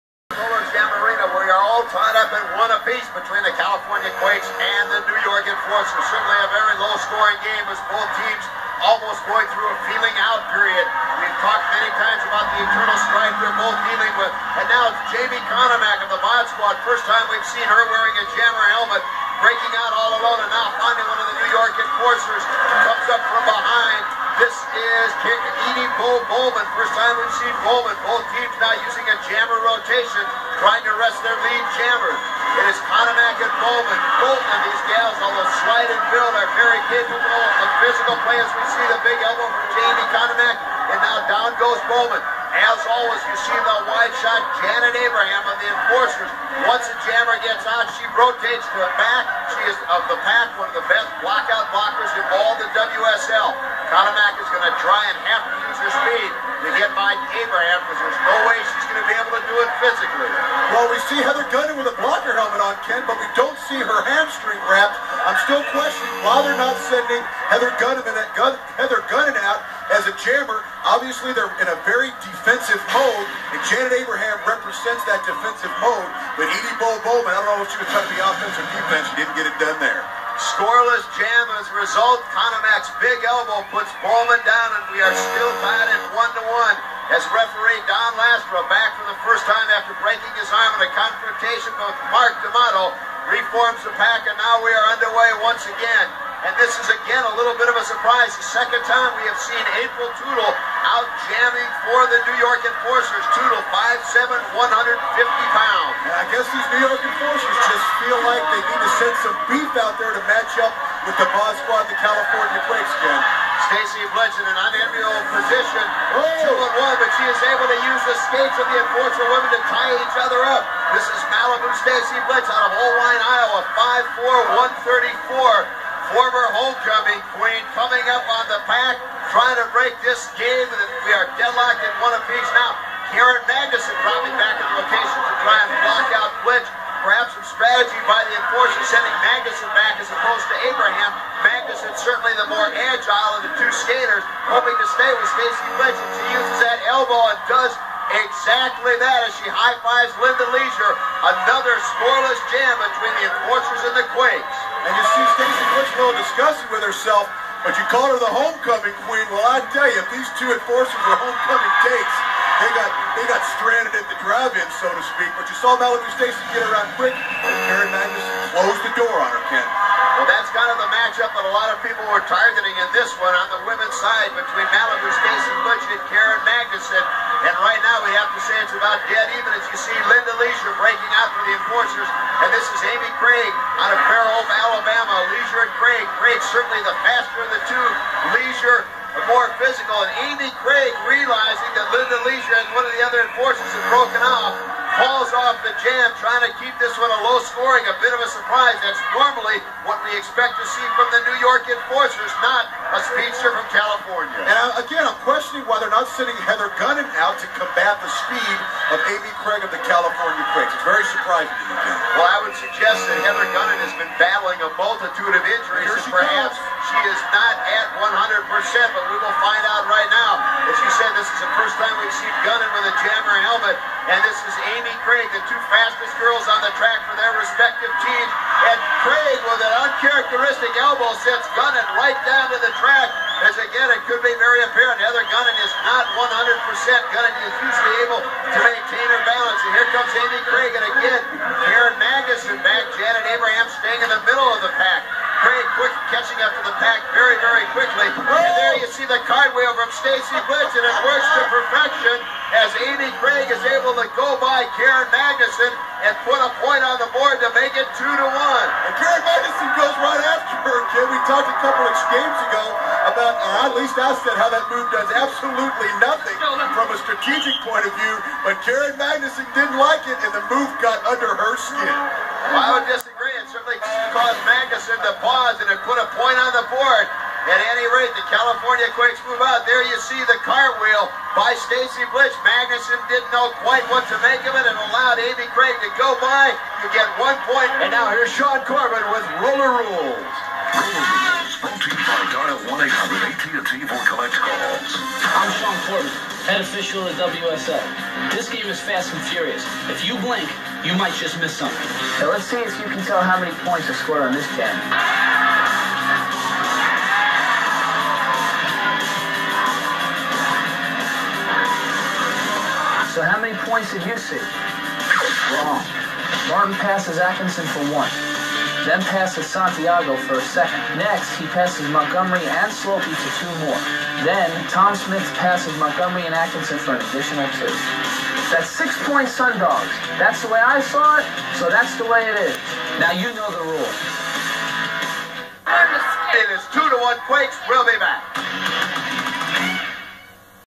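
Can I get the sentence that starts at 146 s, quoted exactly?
She uses that elbow and does exactly that as she high-fives Linda Leisure.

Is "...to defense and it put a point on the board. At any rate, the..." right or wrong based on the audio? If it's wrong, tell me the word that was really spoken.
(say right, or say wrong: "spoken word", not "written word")
wrong: "pause", not "defense".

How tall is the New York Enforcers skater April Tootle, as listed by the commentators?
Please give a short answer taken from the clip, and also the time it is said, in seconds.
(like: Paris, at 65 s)
5'7", at 103 s.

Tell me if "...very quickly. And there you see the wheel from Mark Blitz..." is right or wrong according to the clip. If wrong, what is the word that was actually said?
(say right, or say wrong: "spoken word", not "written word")
wrong: "Stacy", not "Mark".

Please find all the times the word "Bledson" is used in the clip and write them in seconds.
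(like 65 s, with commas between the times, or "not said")
114 s, 122 s.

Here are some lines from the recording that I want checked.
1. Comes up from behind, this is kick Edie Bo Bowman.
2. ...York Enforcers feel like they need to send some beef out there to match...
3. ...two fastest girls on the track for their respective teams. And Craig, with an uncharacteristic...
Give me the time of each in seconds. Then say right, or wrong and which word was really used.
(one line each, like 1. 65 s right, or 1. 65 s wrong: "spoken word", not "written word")
1. 22 s right
2. 106 s right
3. 225 s right.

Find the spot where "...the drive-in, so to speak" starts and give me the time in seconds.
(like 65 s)
164 s.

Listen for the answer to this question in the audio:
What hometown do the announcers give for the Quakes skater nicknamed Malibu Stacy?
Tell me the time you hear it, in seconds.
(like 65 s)
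122 s.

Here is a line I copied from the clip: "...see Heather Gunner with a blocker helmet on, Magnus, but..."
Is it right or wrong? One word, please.
wrong.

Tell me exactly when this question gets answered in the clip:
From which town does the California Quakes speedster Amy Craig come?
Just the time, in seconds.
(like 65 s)
184 s.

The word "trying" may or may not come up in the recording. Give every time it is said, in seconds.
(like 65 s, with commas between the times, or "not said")
30 s, 77 s, 129 s, 196 s.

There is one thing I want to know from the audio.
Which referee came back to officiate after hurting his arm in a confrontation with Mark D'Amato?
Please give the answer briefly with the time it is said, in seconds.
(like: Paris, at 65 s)
Don Lastra, at 87 s.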